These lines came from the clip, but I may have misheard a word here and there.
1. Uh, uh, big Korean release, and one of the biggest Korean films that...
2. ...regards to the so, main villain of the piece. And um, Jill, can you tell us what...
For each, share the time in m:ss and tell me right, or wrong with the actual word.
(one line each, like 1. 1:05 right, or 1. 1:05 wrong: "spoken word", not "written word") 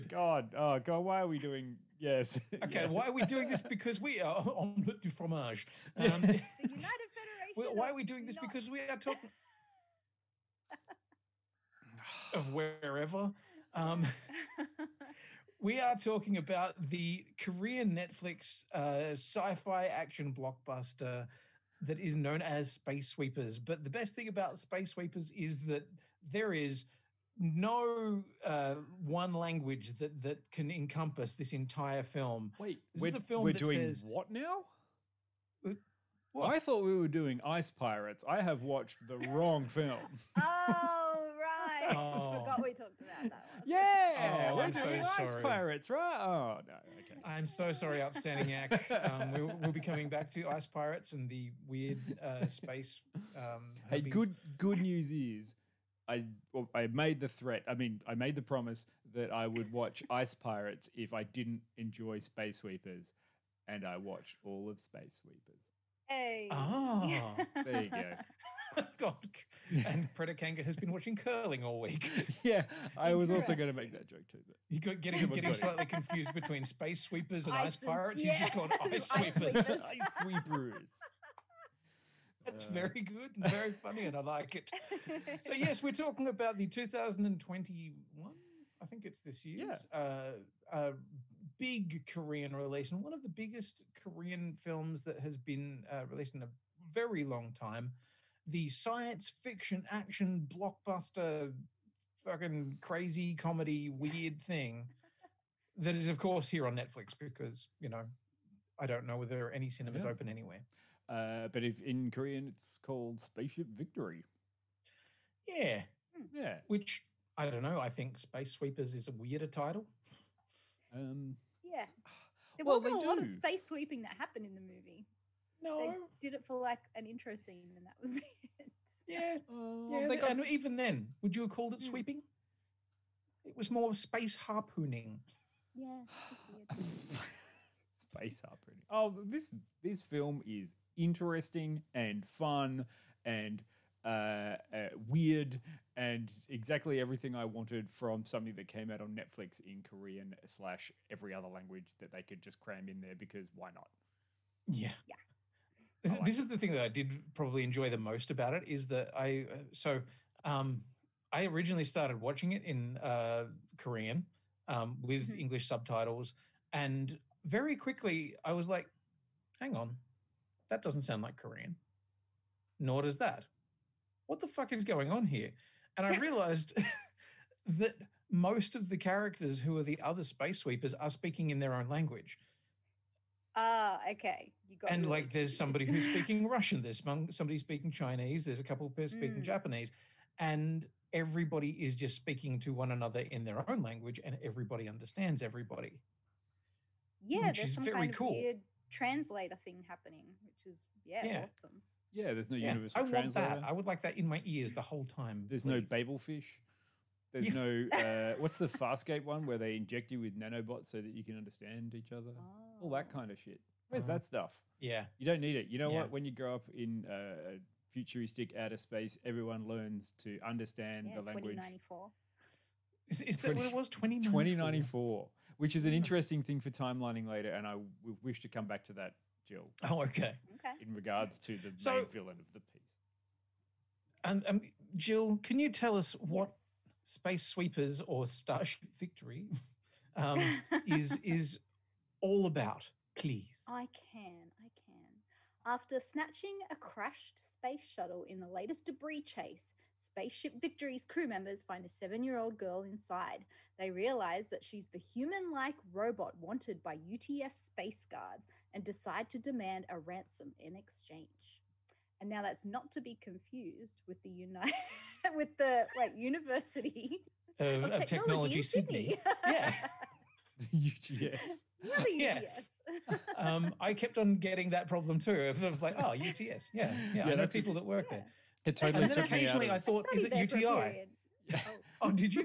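1. 1:29 right
2. 3:50 right.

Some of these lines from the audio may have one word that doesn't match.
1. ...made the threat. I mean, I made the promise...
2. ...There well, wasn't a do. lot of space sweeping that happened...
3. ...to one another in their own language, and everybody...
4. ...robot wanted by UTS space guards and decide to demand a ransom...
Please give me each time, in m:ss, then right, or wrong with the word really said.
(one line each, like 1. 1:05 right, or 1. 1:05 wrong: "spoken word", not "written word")
1. 0:56 right
2. 2:02 right
3. 3:12 right
4. 4:15 right.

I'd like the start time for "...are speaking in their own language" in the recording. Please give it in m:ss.
3:00.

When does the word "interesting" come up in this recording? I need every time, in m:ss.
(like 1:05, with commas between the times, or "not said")
2:20, 3:45.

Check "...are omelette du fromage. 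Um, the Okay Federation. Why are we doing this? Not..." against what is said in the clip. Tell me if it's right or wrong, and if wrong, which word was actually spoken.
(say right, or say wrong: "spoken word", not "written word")
wrong: "United", not "Okay".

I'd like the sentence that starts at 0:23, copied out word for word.
But the best thing about Space Sweepers is that there is no uh, one language that that can encompass this entire film.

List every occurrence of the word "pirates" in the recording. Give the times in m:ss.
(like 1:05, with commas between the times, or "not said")
0:37, 0:45, 0:50, 1:00, 1:17.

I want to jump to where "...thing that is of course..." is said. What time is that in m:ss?
1:44.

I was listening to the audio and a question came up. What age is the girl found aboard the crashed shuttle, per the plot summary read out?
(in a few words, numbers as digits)
7.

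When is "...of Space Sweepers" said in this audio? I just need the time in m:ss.
1:04.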